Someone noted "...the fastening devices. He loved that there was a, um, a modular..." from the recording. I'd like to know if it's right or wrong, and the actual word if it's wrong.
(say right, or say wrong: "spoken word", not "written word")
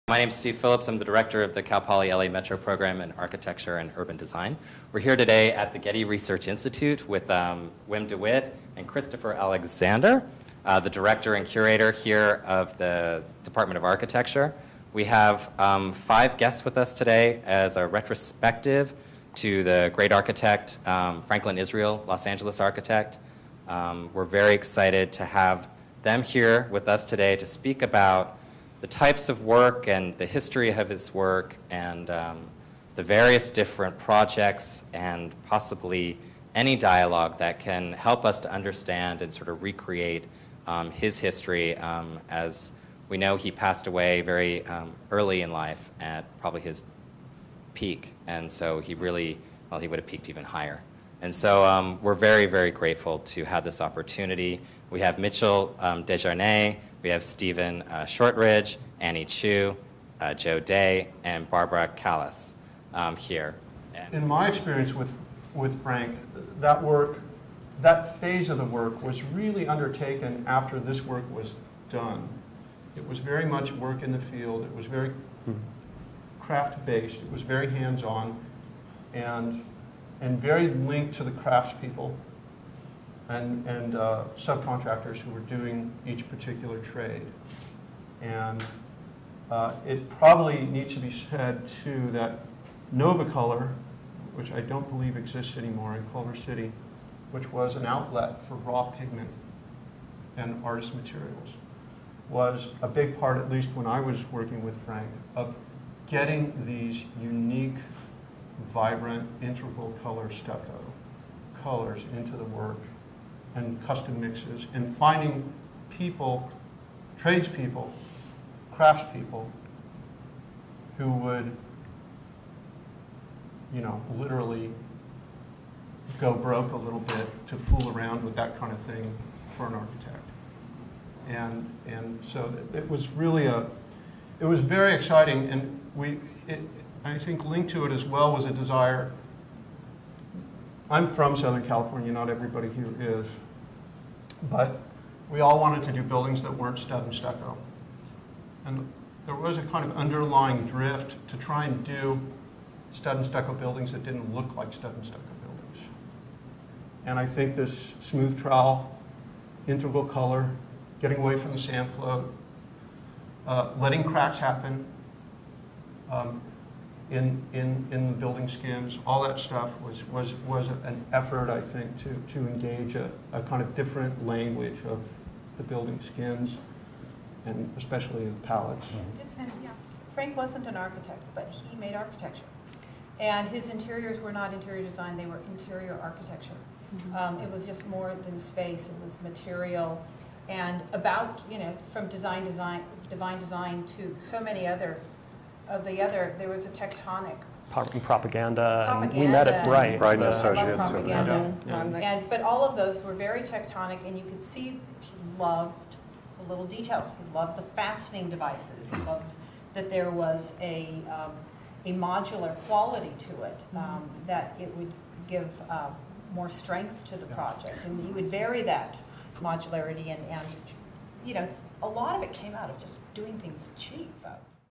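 right.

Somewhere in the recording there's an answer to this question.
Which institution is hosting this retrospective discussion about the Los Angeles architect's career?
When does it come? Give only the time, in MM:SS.
00:05.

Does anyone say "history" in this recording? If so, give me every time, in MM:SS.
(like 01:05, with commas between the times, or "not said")
00:30, 00:41.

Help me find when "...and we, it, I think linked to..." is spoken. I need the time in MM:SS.
02:15.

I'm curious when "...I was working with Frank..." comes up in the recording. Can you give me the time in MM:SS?
01:43.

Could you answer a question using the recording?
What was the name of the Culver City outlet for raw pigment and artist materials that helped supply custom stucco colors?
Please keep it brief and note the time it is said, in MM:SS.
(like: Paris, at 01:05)
Novacolor, at 01:32.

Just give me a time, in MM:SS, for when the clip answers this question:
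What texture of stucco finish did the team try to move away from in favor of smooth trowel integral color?
02:41.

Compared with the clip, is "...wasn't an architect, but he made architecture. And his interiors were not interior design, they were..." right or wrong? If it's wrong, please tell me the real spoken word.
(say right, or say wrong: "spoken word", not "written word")
right.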